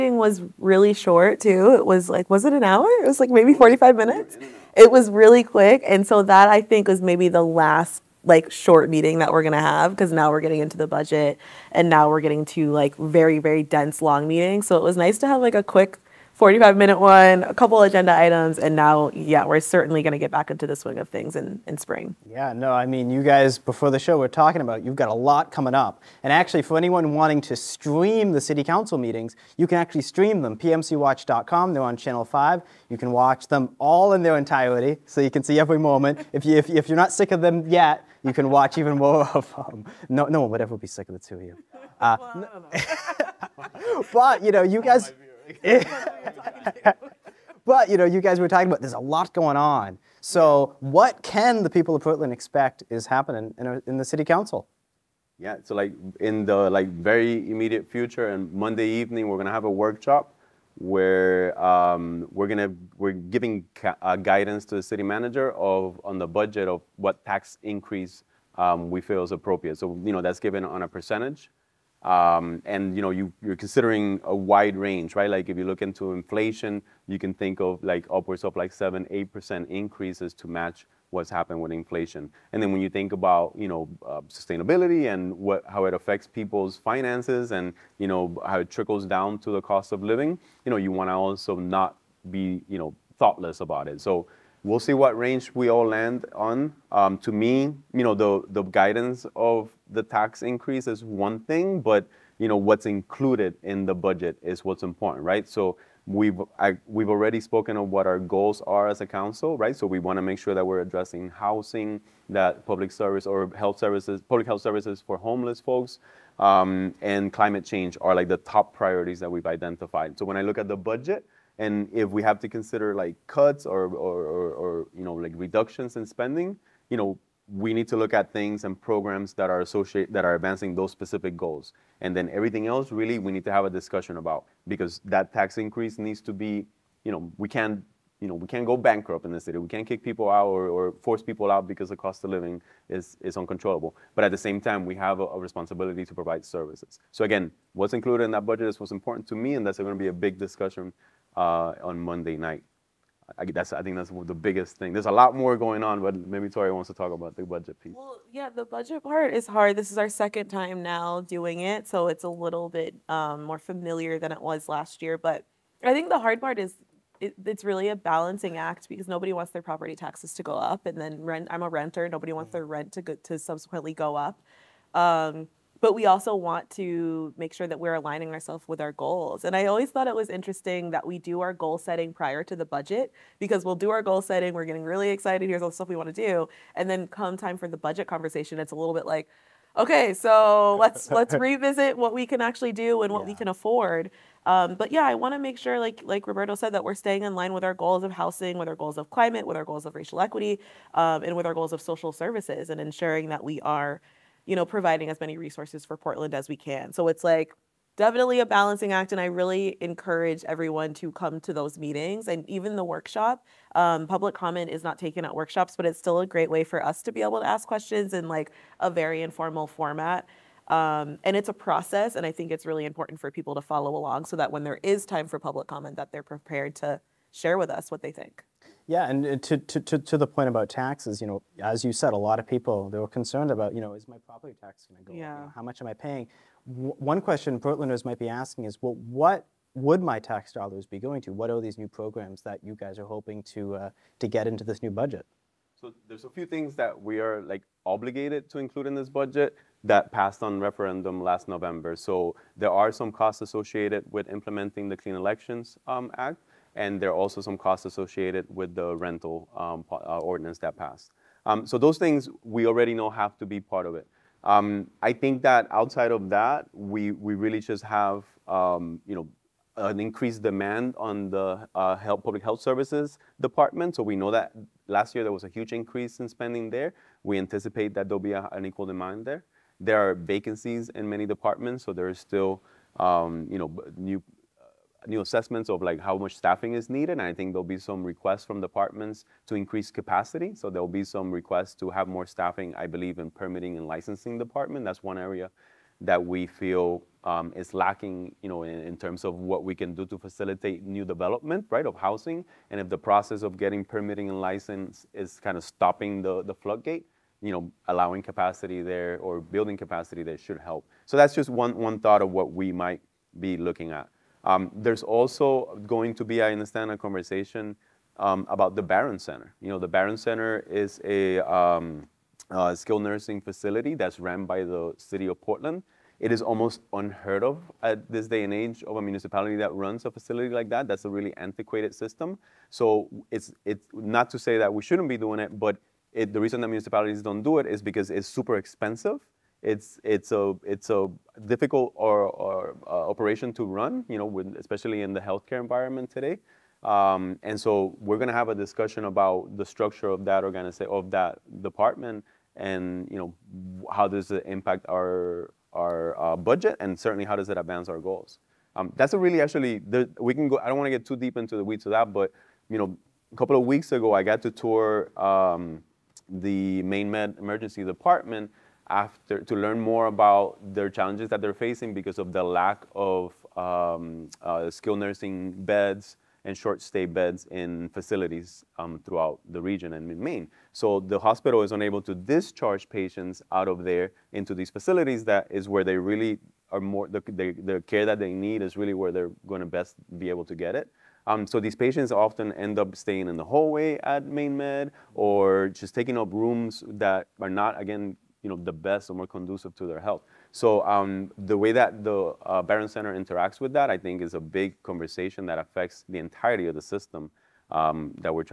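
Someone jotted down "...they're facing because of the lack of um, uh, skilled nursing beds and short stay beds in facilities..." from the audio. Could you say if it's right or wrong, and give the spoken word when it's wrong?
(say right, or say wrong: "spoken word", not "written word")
right.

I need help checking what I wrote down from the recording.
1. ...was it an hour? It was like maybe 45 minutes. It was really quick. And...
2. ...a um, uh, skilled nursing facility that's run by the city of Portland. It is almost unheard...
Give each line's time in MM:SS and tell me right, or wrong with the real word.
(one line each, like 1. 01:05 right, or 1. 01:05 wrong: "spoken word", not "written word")
1. 00:02 right
2. 05:21 right.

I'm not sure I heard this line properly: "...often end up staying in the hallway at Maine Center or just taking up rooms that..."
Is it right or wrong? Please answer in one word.
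wrong.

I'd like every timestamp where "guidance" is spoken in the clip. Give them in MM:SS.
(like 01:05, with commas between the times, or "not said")
01:04, 01:38.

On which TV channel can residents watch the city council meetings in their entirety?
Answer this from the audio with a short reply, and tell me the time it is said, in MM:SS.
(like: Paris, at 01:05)
Channel 5, at 00:31.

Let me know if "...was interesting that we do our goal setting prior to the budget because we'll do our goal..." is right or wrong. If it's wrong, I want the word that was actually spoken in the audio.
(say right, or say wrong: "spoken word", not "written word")
right.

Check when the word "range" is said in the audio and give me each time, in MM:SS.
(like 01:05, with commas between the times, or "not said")
01:14, 01:35.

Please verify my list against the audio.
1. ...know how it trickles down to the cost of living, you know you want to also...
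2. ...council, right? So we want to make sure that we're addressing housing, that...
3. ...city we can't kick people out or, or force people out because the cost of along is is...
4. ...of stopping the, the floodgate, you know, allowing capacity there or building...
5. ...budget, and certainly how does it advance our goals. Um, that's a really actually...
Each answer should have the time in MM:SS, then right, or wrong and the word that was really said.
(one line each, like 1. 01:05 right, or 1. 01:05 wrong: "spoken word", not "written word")
1. 01:28 right
2. 01:49 right
3. 02:19 wrong: "living", not "along"
4. 05:05 right
5. 05:56 right.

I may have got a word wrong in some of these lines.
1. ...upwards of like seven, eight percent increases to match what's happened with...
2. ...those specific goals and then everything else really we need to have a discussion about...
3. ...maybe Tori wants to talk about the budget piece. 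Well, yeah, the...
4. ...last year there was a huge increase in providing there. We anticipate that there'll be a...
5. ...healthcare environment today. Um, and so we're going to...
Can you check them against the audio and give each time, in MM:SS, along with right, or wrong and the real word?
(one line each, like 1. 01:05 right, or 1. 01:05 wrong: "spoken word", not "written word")
1. 01:18 right
2. 02:10 right
3. 02:36 right
4. 04:34 wrong: "spending", not "providing"
5. 05:45 right.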